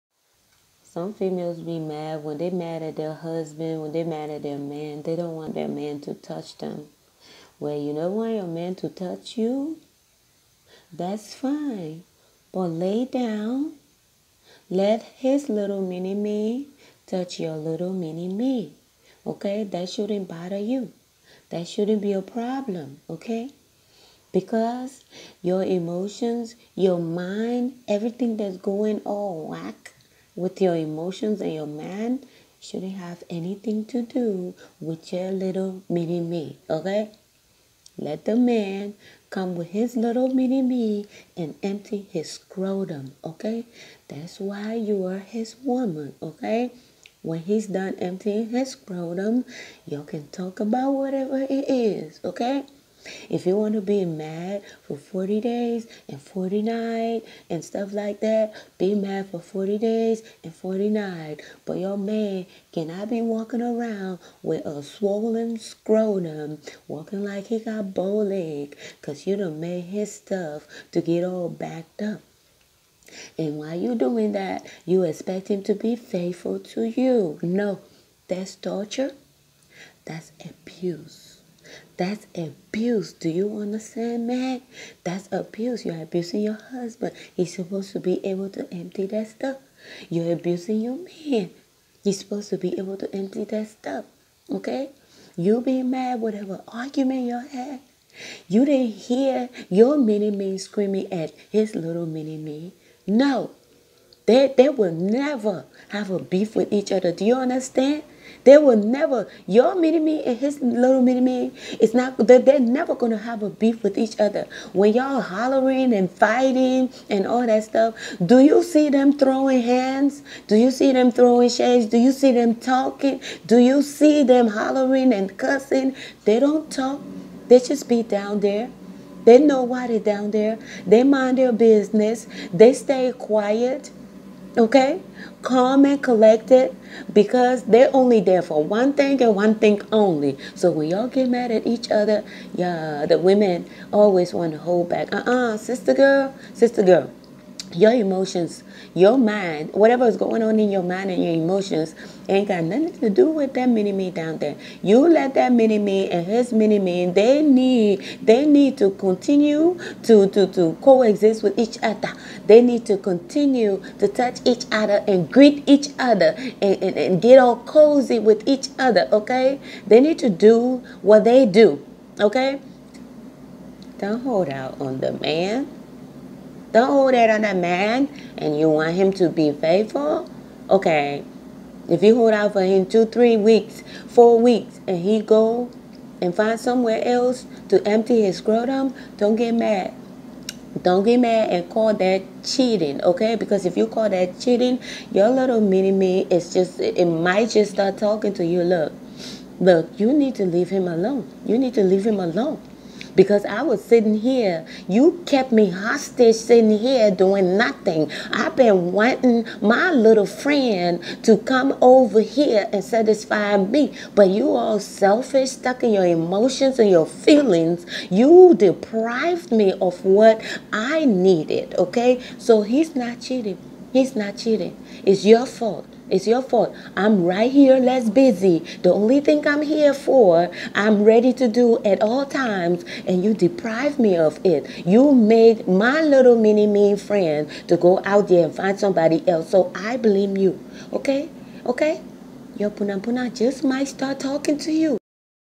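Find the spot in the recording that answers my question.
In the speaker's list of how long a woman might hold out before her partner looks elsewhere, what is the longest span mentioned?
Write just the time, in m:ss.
3:04.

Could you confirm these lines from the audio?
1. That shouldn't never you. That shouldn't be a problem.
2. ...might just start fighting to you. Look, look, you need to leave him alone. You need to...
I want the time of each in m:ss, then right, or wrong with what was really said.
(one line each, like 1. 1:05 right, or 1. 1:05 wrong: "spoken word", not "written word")
1. 0:19 wrong: "bother", not "never"
2. 3:17 wrong: "talking", not "fighting".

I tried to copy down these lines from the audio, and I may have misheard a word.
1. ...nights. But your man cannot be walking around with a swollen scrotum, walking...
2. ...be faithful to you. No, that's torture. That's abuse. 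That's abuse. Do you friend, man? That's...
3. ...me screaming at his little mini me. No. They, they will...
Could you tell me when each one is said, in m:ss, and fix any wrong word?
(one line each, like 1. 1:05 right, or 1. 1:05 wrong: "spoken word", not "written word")
1. 1:00 right
2. 1:15 wrong: "understand", not "friend"
3. 1:40 right.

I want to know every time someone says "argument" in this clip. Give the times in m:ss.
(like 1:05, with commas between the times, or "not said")
1:36.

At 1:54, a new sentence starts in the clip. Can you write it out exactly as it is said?
When y'all hollering and fighting and all that stuff, do you see them throwing hands?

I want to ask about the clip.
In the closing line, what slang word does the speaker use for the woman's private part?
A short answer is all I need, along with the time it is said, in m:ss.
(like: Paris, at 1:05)
punapuna, at 4:02.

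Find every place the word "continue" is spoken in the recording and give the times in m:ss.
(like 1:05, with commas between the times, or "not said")
2:38, 2:42.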